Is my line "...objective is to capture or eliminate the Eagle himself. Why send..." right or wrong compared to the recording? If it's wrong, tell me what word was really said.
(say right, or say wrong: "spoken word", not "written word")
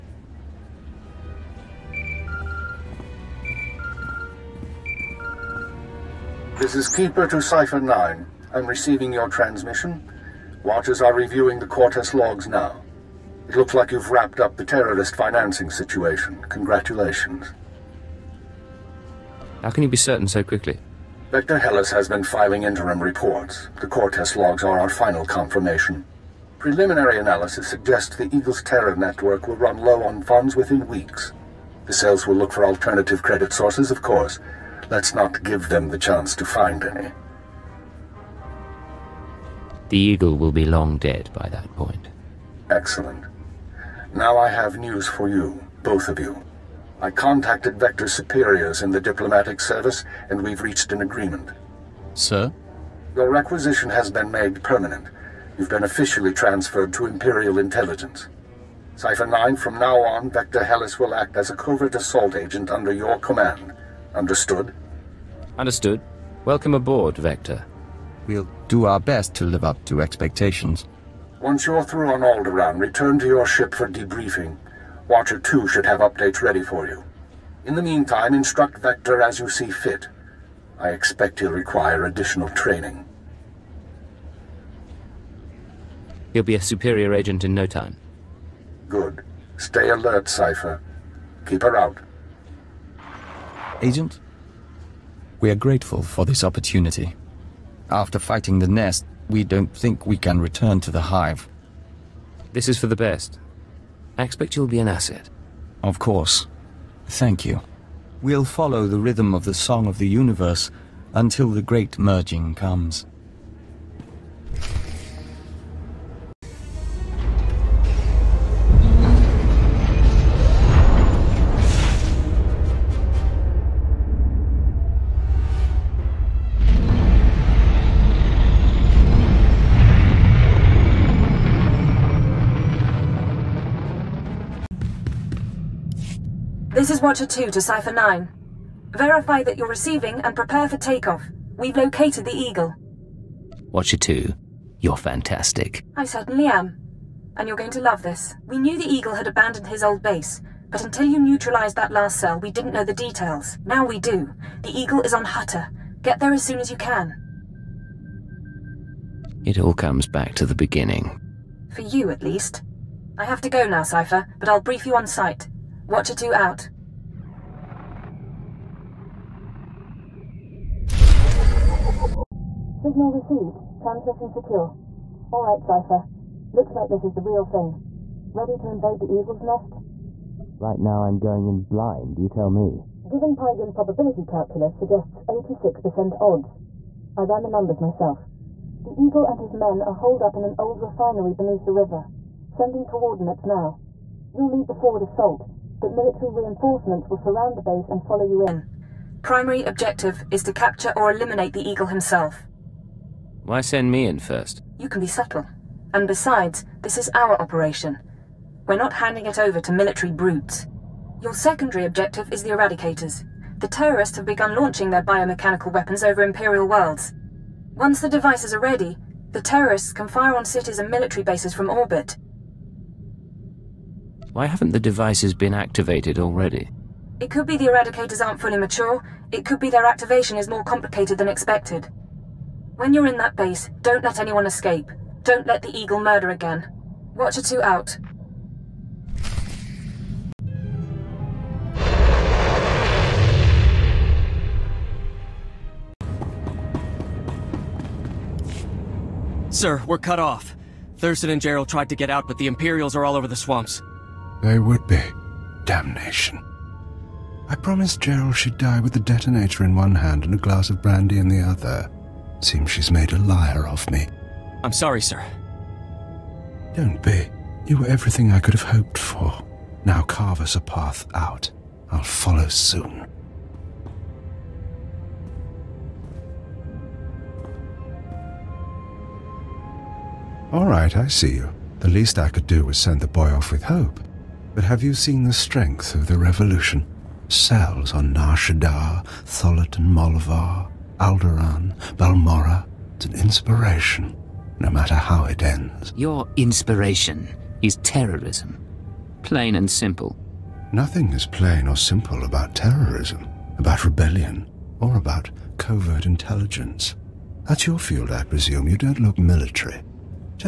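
right.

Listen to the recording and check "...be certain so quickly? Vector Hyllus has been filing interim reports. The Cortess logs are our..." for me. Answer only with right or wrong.
right.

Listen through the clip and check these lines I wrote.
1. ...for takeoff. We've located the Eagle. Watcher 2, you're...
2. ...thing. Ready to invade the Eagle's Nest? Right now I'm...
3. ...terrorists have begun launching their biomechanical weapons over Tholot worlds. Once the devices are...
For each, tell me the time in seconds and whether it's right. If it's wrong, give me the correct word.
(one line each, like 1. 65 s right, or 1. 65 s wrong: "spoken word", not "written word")
1. 140 s right
2. 177 s right
3. 213 s wrong: "Imperial", not "Tholot".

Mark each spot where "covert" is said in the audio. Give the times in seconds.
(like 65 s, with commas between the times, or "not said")
61 s, 305 s.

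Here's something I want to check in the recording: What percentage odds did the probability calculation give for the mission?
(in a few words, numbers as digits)
86%.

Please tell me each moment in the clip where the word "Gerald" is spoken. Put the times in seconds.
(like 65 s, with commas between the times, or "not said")
251 s, 258 s.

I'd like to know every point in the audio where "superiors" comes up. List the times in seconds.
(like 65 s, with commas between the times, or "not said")
48 s, 86 s.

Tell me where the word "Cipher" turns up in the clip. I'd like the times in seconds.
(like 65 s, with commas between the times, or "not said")
7 s, 58 s, 90 s, 137 s, 163 s, 175 s.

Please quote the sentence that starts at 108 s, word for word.
We'll follow the rhythm of the Song of the Universe until the great merging comes.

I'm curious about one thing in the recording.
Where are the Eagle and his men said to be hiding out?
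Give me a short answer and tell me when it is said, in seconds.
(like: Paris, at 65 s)
An old refinery, at 190 s.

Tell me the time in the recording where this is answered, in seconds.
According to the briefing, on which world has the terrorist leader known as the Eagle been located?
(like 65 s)
155 s.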